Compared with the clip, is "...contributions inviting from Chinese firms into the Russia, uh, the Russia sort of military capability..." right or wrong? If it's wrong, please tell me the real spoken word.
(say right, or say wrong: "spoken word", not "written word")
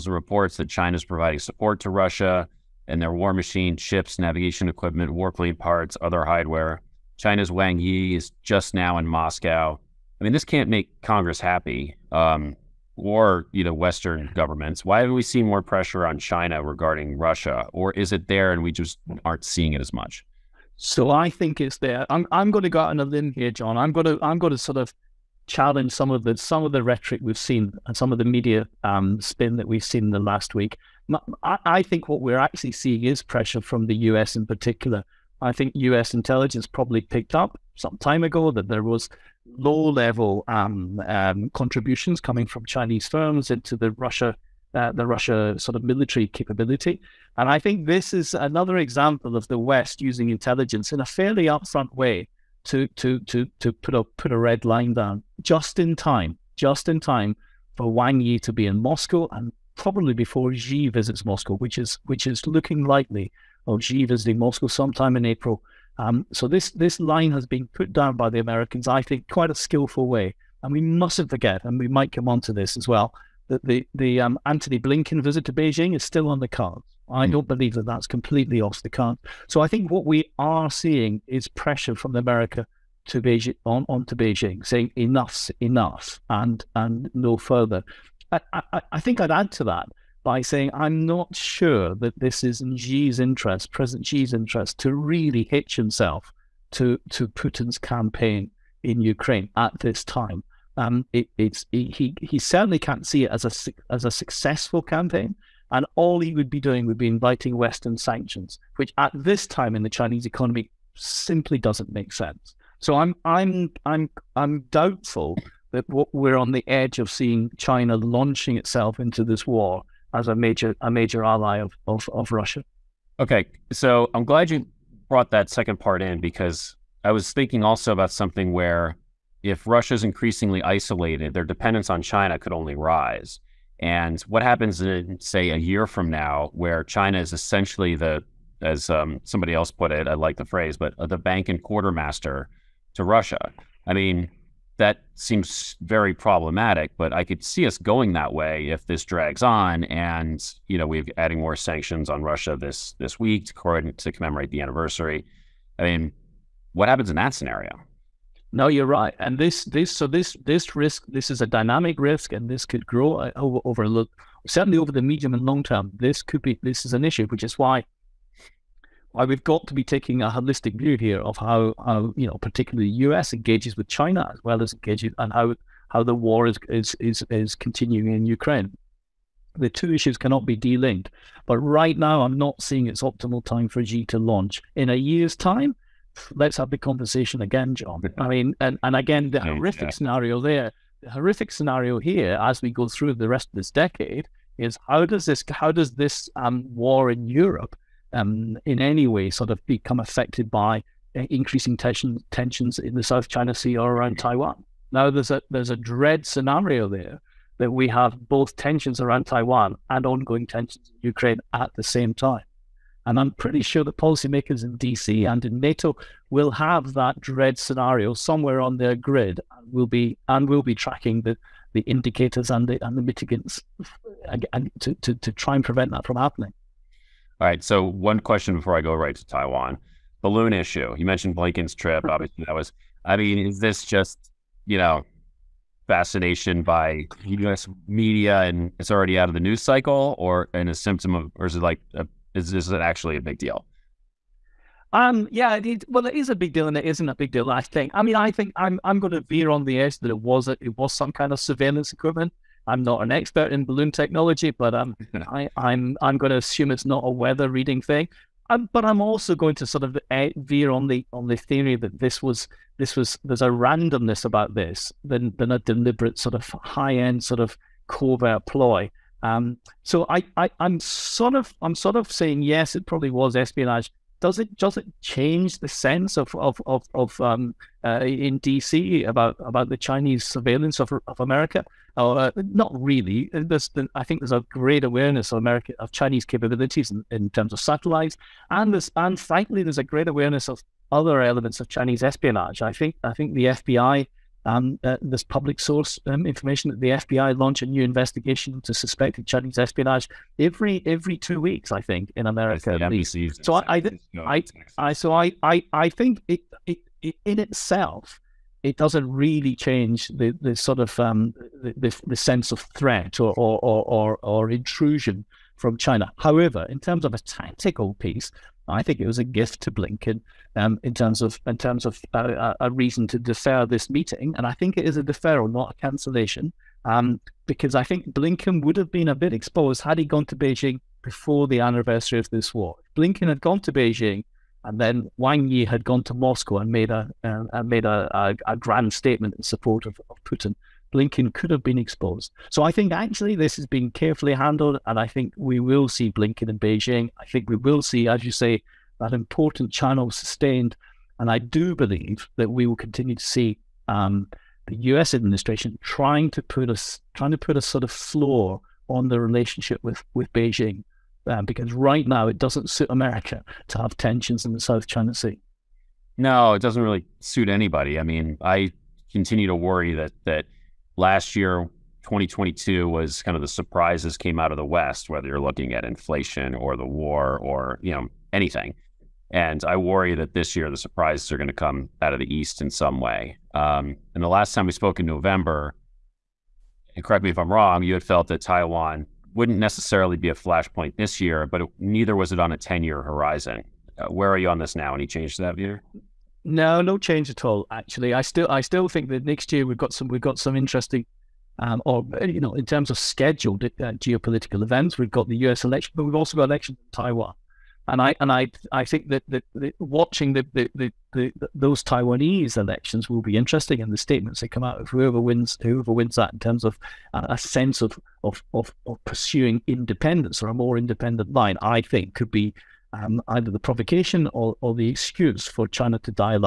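wrong: "coming", not "inviting".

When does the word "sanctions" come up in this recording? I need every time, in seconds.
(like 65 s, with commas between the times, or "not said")
107 s, 151 s.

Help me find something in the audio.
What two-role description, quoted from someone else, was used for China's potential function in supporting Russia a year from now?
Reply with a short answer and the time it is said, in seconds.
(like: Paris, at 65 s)
bank and quartermaster, at 141 s.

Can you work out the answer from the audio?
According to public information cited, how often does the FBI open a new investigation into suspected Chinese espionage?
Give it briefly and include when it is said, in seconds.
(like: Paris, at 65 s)
every two weeks, at 300 s.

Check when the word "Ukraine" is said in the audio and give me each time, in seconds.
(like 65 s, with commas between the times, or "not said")
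99 s, 178 s, 211 s.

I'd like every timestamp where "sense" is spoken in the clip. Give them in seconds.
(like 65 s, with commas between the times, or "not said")
112 s, 275 s, 312 s, 417 s.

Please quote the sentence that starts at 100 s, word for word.
Um, it, it's he he certainly can't see it as a as a successful campaign.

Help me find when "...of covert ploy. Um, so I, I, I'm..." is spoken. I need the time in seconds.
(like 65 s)
267 s.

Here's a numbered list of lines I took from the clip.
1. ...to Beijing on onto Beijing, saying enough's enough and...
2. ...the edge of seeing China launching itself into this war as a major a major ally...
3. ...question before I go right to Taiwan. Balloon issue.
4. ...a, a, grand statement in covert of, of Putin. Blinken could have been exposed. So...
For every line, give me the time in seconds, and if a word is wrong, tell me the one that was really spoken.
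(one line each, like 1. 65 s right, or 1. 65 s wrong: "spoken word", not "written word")
1. 83 s right
2. 116 s right
3. 228 s right
4. 338 s wrong: "support", not "covert".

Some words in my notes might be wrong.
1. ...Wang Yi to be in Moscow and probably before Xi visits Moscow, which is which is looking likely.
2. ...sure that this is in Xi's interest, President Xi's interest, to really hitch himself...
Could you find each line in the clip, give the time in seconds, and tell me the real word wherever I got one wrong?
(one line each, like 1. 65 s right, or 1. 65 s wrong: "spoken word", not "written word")
1. 57 s right
2. 91 s right.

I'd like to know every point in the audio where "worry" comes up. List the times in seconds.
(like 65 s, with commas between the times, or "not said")
369 s, 379 s.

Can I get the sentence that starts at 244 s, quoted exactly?
Um, yeah, it is, well, it is a big deal, and it isn't a big deal.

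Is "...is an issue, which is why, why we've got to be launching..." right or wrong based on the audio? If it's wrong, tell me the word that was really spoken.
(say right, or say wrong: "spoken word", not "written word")
wrong: "taking", not "launching".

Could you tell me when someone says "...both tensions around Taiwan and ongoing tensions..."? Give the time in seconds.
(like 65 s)
208 s.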